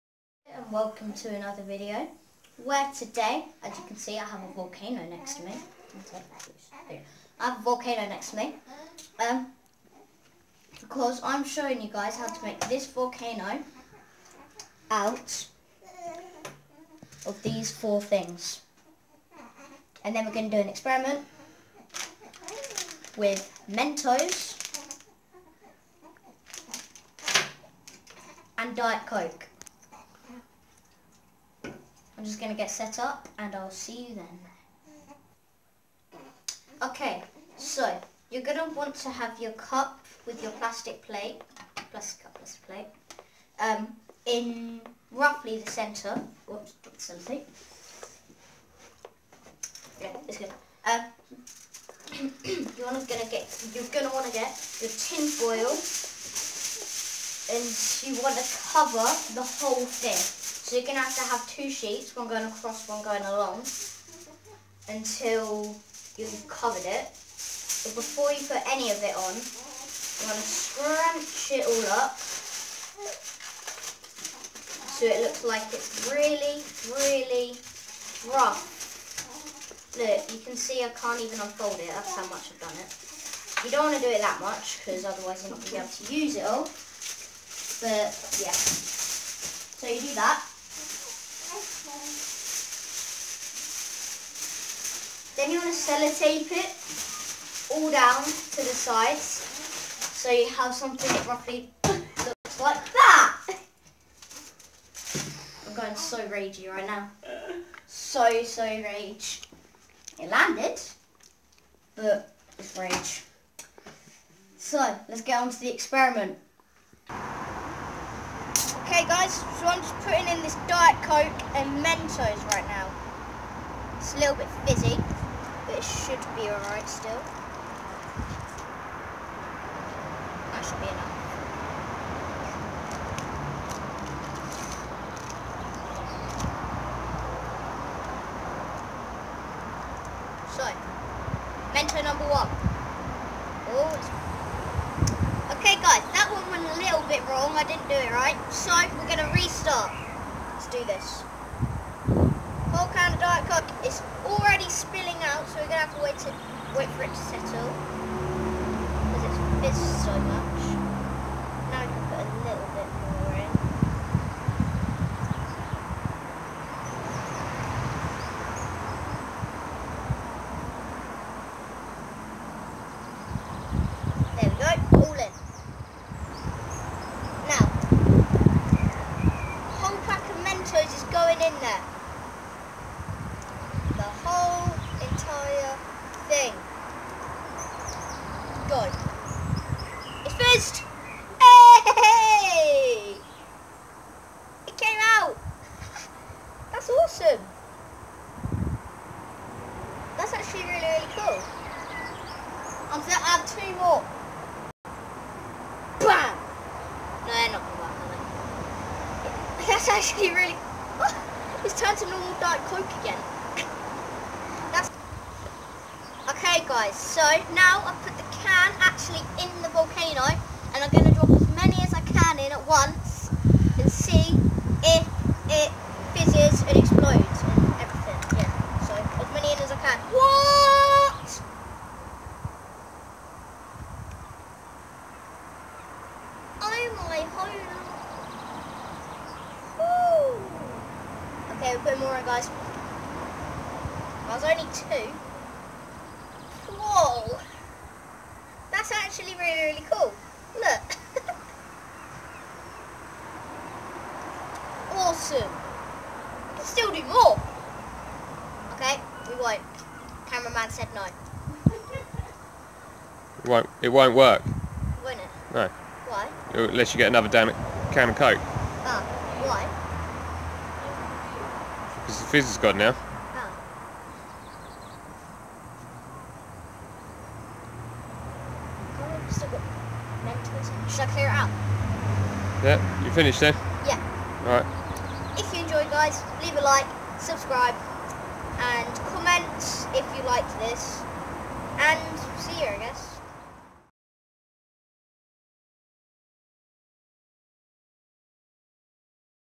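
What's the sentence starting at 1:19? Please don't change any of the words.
Look, you can see I can't even unfold it.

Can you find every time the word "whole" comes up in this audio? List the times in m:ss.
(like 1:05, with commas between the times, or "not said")
0:59, 2:32, 2:59.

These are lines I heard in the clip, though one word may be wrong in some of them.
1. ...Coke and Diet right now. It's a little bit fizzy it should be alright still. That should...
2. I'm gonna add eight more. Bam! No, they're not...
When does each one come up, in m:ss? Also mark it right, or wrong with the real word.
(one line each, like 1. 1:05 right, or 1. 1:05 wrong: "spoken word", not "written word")
1. 2:01 wrong: "Mentos", not "Diet"
2. 3:22 wrong: "two", not "eight".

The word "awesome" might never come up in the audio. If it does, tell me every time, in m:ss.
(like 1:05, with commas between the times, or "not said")
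3:16, 4:15.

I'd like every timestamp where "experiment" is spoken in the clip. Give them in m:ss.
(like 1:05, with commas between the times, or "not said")
0:20, 1:55.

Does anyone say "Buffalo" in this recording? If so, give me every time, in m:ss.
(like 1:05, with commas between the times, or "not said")
not said.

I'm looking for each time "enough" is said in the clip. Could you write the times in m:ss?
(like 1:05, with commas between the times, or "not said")
2:10.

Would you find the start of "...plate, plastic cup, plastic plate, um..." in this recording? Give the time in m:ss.
0:41.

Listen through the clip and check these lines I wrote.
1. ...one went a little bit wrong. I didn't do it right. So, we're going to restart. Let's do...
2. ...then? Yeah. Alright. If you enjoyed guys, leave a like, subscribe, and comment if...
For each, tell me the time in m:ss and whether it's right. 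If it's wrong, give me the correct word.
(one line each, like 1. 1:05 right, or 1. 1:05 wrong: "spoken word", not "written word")
1. 2:26 right
2. 4:43 right.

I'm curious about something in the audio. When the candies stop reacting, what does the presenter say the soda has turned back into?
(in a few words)
Normal Diet Coke.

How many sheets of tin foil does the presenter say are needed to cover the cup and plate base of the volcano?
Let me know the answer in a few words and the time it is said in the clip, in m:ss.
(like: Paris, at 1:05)
2, at 1:01.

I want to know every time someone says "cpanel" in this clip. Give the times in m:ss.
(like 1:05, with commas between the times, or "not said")
not said.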